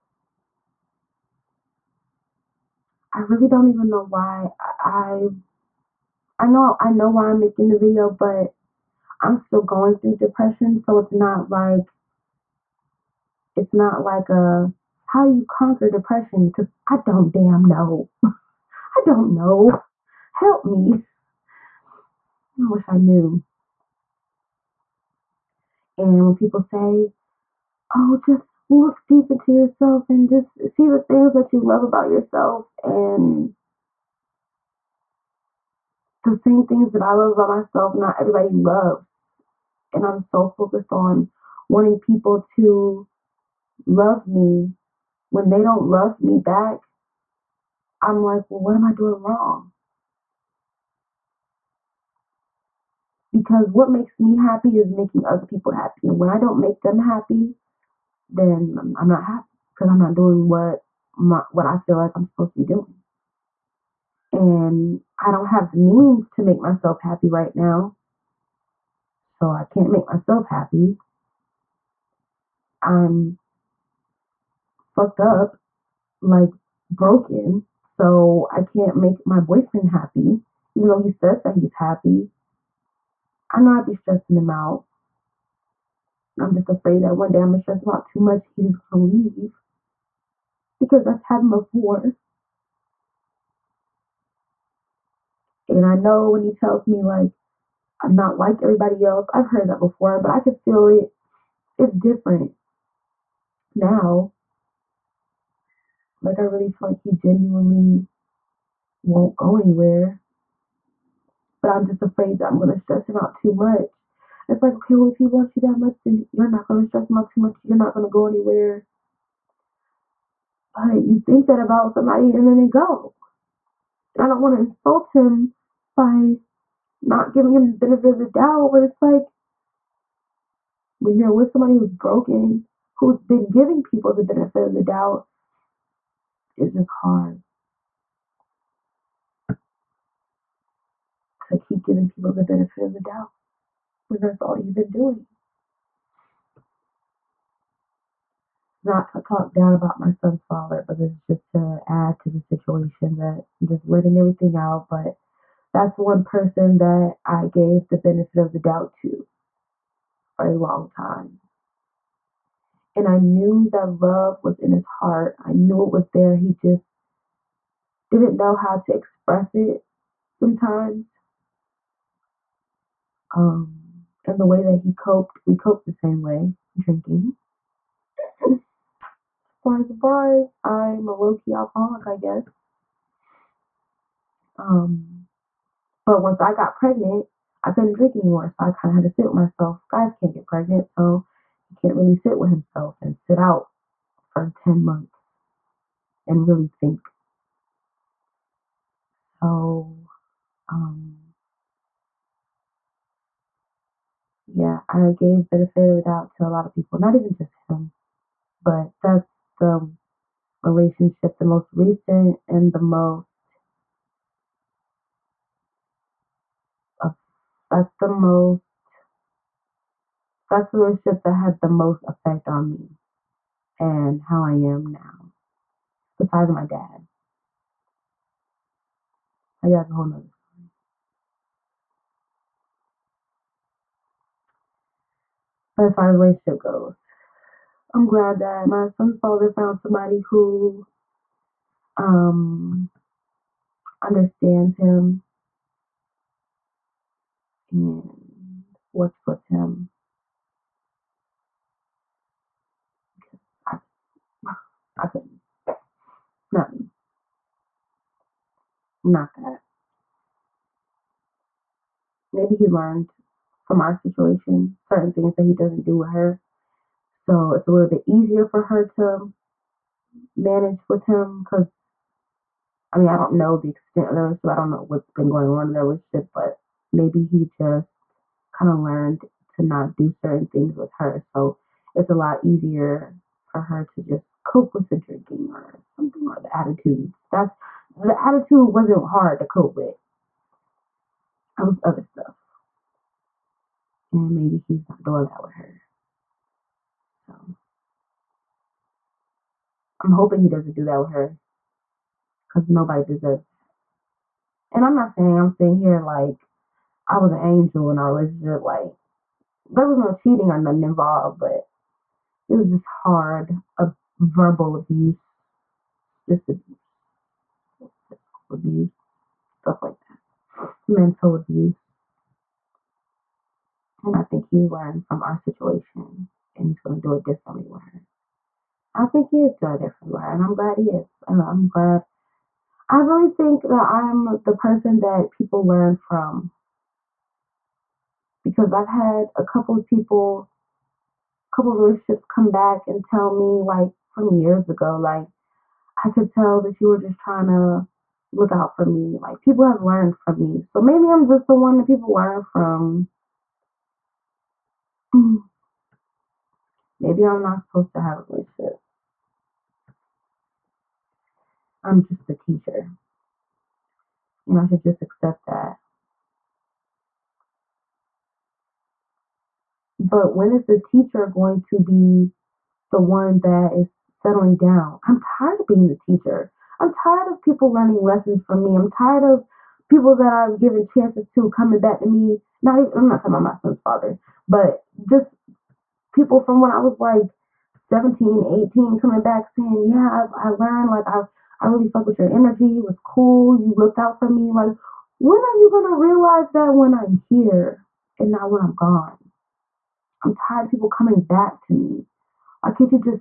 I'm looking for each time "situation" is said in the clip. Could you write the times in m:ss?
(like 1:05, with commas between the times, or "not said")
2:32, 4:23, 5:25.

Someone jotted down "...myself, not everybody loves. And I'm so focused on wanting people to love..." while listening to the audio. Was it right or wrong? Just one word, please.
right.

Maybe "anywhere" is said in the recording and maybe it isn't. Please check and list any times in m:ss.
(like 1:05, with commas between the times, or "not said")
1:49, 1:58.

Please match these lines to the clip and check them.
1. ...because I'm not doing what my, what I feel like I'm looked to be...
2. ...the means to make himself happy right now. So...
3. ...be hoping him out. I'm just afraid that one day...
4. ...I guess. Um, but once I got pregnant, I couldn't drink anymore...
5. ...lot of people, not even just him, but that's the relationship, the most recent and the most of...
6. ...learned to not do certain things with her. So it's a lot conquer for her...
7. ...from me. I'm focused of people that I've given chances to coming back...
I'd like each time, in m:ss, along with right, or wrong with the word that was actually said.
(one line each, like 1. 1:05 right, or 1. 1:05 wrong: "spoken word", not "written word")
1. 0:59 wrong: "supposed", not "looked"
2. 1:05 wrong: "myself", not "himself"
3. 1:23 wrong: "stressing", not "hoping"
4. 3:02 right
5. 3:26 right
6. 4:38 wrong: "easier", not "conquer"
7. 6:18 wrong: "tired", not "focused".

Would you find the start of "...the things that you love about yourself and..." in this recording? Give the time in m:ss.
0:30.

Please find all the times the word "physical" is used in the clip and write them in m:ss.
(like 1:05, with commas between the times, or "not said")
5:18.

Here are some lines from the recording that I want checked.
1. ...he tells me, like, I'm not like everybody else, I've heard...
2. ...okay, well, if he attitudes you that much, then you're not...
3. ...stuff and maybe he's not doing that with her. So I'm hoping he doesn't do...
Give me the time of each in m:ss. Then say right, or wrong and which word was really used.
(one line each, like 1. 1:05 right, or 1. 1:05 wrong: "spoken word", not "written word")
1. 1:36 right
2. 1:54 wrong: "loves", not "attitudes"
3. 4:52 right.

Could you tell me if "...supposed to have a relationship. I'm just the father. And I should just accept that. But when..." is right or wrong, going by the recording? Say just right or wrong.
wrong.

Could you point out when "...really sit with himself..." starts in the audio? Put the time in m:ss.
3:11.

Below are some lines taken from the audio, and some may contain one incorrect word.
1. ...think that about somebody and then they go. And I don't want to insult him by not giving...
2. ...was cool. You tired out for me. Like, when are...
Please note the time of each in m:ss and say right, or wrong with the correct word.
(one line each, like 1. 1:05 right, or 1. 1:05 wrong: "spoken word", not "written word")
1. 2:01 right
2. 6:32 wrong: "looked", not "tired".